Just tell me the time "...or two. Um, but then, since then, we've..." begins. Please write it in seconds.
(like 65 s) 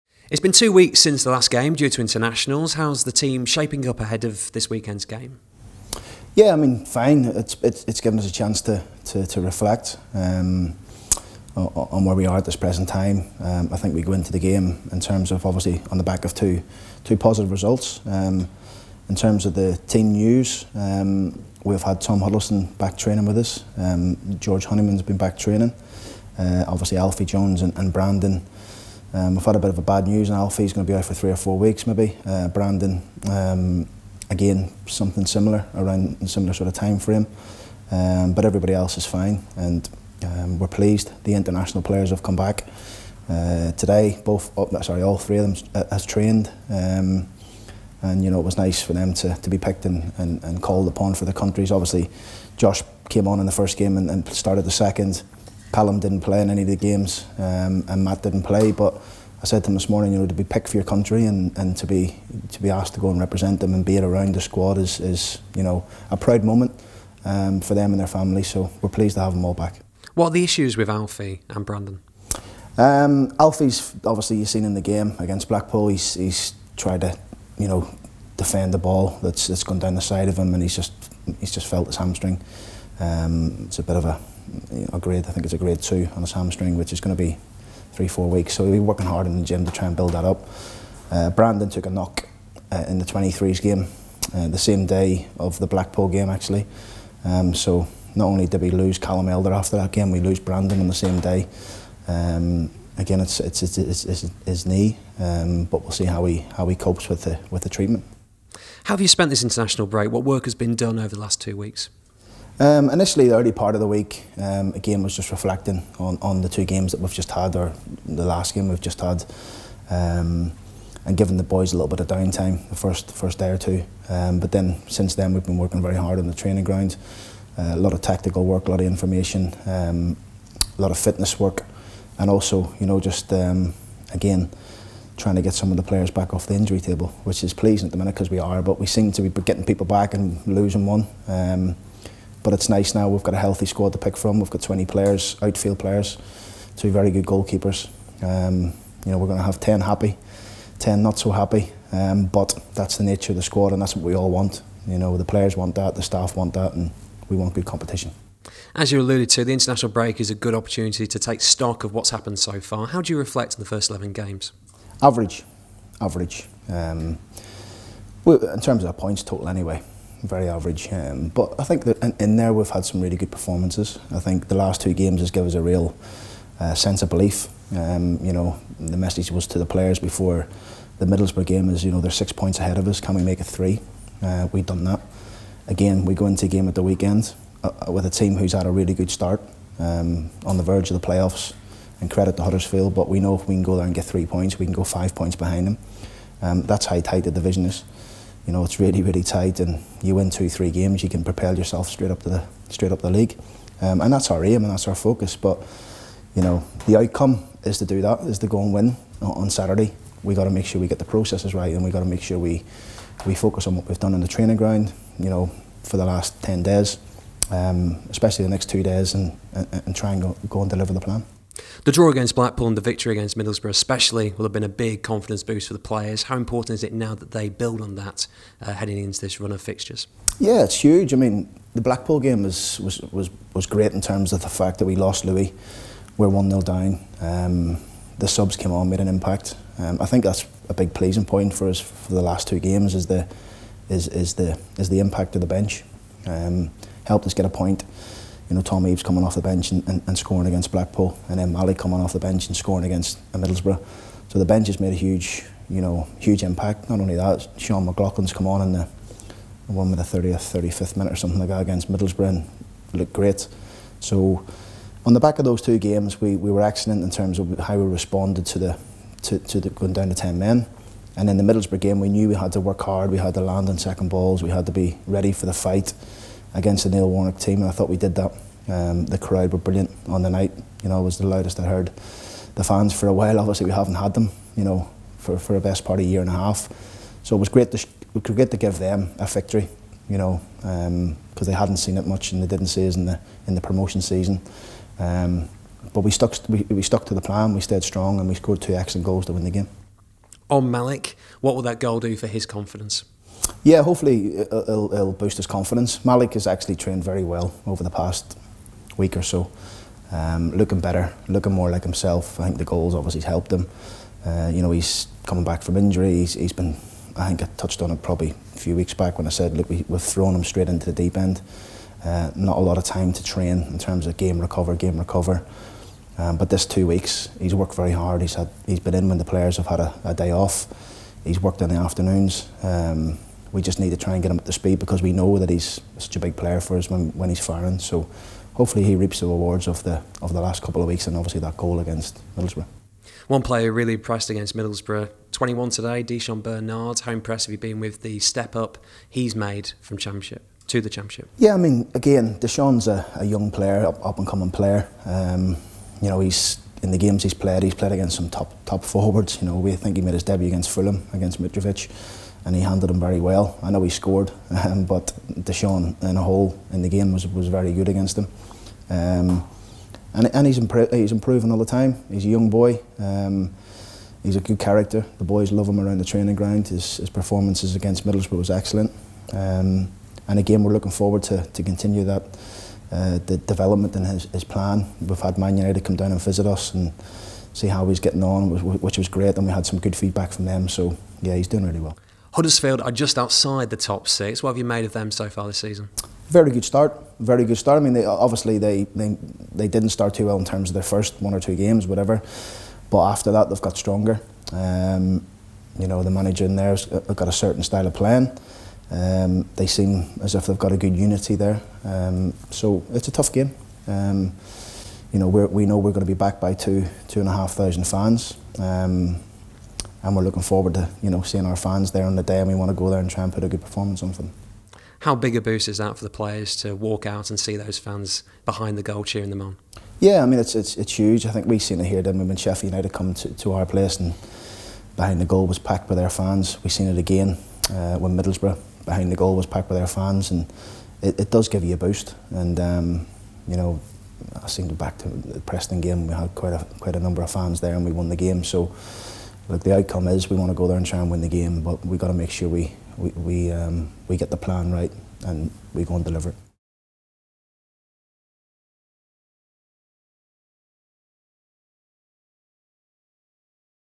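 123 s.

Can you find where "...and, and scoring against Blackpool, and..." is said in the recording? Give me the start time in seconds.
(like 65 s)
249 s.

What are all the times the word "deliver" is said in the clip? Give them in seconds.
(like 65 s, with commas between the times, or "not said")
220 s, 456 s.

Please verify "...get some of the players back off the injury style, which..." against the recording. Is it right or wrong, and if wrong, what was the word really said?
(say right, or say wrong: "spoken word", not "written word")
wrong: "table", not "style".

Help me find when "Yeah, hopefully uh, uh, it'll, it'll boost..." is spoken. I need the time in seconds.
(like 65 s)
303 s.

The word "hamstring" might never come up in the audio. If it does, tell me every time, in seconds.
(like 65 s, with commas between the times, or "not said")
81 s, 86 s.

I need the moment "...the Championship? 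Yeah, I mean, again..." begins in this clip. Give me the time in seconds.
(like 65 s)
350 s.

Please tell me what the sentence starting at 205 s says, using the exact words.
But you know the outcome is to do that, is to go and win on Saturday.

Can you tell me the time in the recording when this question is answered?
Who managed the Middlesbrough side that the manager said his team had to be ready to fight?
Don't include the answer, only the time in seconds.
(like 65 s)
276 s.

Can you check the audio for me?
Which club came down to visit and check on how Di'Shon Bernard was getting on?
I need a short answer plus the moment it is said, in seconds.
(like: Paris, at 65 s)
Man United, at 385 s.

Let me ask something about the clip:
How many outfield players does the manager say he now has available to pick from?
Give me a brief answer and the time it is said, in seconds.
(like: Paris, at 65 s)
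20, at 144 s.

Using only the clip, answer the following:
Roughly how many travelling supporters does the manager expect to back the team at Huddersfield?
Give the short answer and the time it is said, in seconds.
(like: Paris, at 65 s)
2,500, at 417 s.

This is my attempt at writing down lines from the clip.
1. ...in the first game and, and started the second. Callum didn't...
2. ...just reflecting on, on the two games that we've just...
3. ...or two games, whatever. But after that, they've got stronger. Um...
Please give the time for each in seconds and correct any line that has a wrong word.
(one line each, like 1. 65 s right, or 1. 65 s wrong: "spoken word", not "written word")
1. 53 s right
2. 115 s right
3. 401 s right.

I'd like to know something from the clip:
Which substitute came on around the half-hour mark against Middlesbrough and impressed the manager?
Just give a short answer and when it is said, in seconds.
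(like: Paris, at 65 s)
Sean McLoughlin, at 257 s.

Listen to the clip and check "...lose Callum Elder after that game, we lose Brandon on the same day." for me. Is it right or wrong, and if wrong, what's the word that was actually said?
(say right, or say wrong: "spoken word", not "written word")
right.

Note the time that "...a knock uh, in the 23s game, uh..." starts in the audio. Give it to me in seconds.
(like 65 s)
91 s.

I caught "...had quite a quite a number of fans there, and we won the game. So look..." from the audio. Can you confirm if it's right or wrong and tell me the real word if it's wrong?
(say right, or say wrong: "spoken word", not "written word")
right.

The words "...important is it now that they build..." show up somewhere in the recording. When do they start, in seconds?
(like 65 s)
226 s.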